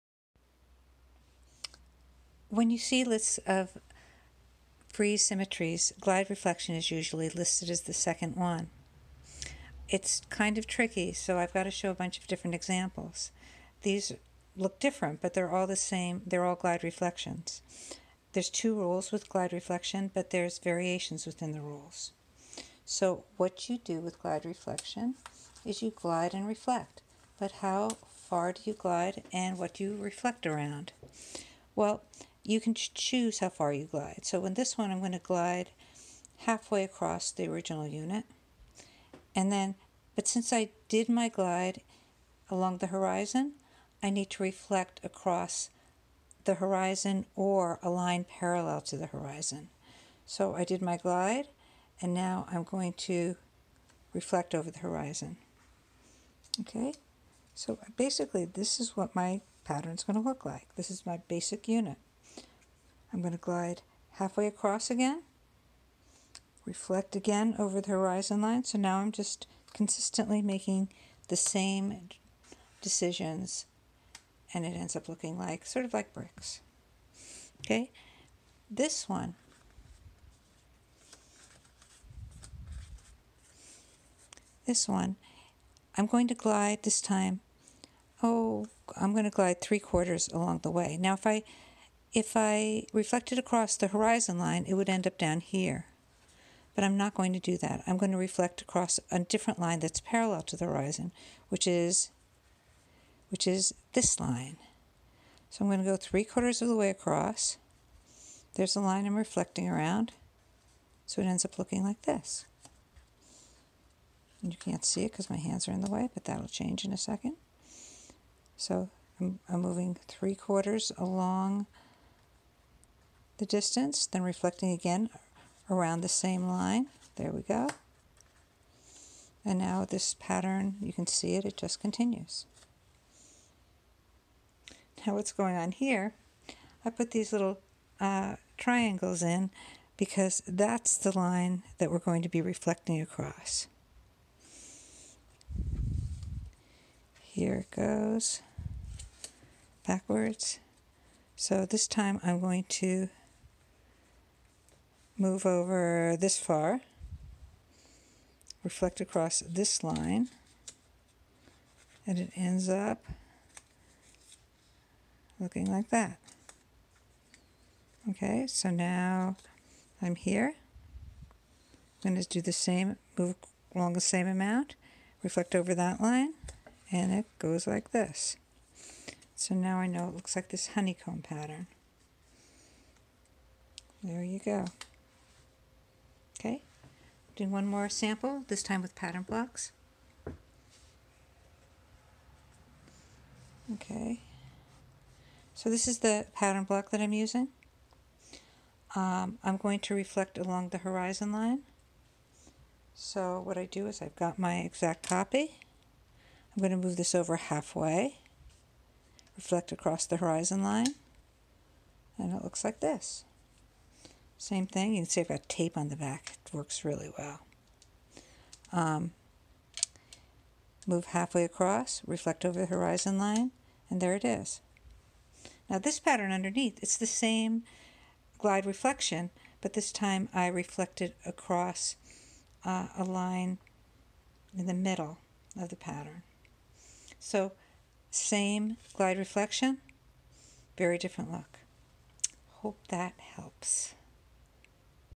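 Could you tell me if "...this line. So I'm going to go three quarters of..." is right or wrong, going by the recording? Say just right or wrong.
right.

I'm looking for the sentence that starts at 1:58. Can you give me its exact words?
So I'm, I'm moving three quarters along the distance, then reflecting again around the same line.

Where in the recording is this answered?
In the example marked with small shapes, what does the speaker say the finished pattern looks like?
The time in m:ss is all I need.
3:00.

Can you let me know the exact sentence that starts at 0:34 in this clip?
So in this one, I'm going to glide halfway across the original unit.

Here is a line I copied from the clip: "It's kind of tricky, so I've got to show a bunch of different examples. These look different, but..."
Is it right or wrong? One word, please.
right.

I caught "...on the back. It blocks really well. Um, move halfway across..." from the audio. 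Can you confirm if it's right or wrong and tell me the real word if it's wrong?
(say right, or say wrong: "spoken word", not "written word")
wrong: "works", not "blocks".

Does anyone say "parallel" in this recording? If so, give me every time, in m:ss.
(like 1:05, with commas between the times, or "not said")
0:48, 1:40.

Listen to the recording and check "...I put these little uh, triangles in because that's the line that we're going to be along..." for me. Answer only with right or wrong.
wrong.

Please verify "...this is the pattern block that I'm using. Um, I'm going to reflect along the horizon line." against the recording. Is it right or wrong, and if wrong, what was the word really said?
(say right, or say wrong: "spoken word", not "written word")
right.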